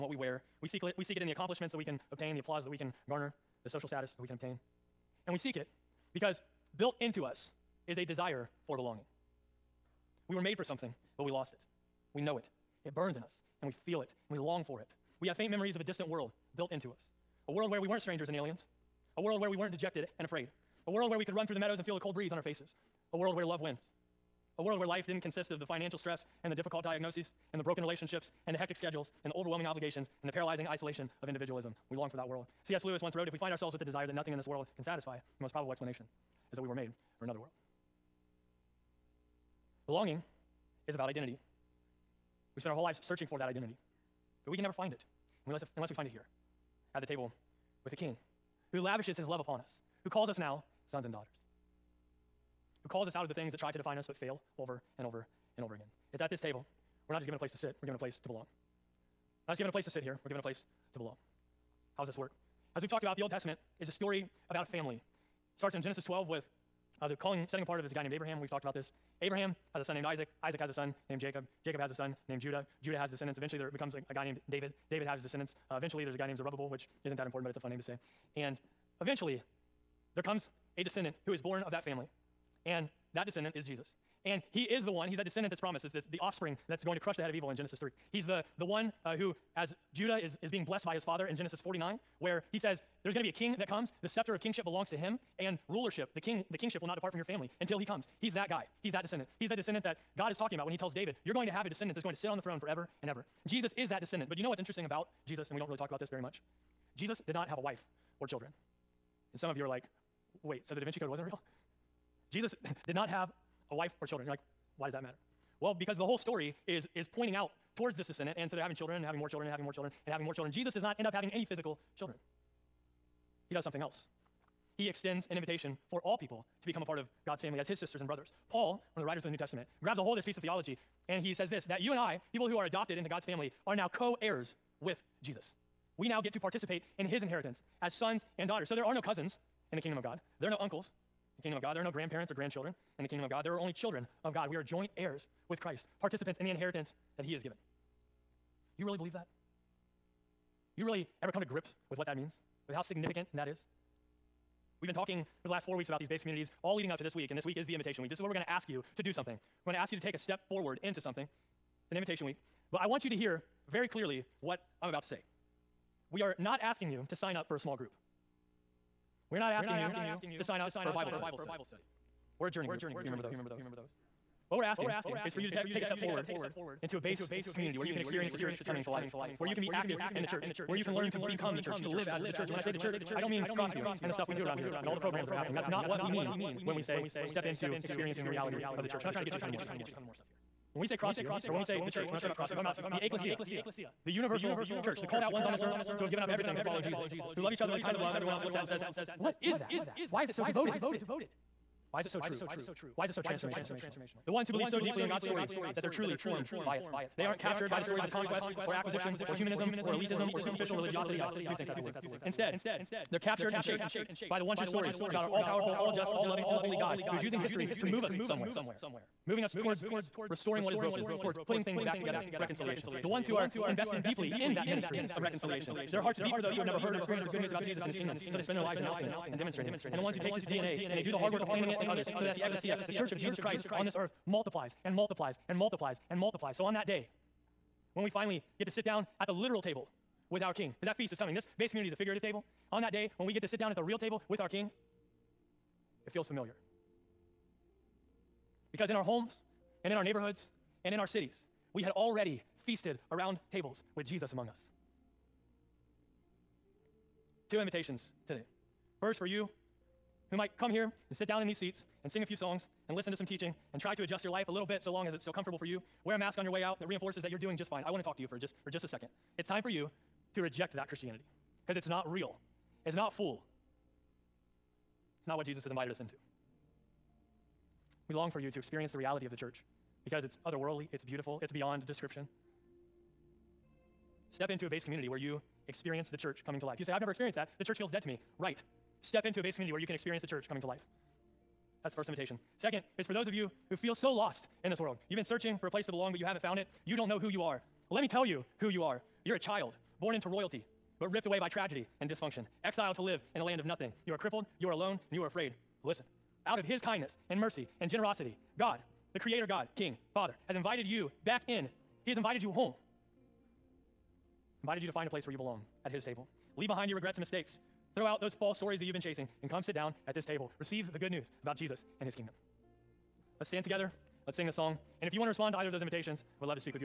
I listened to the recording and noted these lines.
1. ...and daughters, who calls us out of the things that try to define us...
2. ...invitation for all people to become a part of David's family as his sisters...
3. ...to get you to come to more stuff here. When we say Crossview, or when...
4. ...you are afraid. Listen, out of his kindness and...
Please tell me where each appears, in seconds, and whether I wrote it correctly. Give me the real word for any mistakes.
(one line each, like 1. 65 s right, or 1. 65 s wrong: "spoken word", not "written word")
1. 51 s right
2. 125 s wrong: "God", not "David"
3. 189 s right
4. 305 s right.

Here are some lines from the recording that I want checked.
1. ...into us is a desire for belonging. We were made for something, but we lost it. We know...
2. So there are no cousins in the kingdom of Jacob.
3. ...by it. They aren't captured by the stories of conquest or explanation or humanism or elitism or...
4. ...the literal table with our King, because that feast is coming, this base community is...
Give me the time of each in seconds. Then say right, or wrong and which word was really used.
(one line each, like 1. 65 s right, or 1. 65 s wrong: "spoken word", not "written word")
1. 7 s right
2. 138 s wrong: "God", not "Jacob"
3. 206 s wrong: "acquisition", not "explanation"
4. 239 s right.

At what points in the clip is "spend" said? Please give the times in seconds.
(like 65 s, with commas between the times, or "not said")
42 s, 228 s.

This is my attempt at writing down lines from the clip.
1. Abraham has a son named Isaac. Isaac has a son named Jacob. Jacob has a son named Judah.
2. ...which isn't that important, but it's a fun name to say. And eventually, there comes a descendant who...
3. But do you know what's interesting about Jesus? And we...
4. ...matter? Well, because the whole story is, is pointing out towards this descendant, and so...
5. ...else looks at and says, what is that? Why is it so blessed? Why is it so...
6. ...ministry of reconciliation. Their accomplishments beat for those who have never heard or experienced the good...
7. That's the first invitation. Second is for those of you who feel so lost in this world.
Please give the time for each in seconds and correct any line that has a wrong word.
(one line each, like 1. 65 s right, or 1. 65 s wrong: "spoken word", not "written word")
1. 69 s right
2. 76 s right
3. 104 s right
4. 115 s right
5. 198 s wrong: "devoted", not "blessed"
6. 224 s wrong: "hearts", not "accomplishments"
7. 291 s right.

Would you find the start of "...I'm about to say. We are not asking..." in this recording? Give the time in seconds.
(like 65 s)
164 s.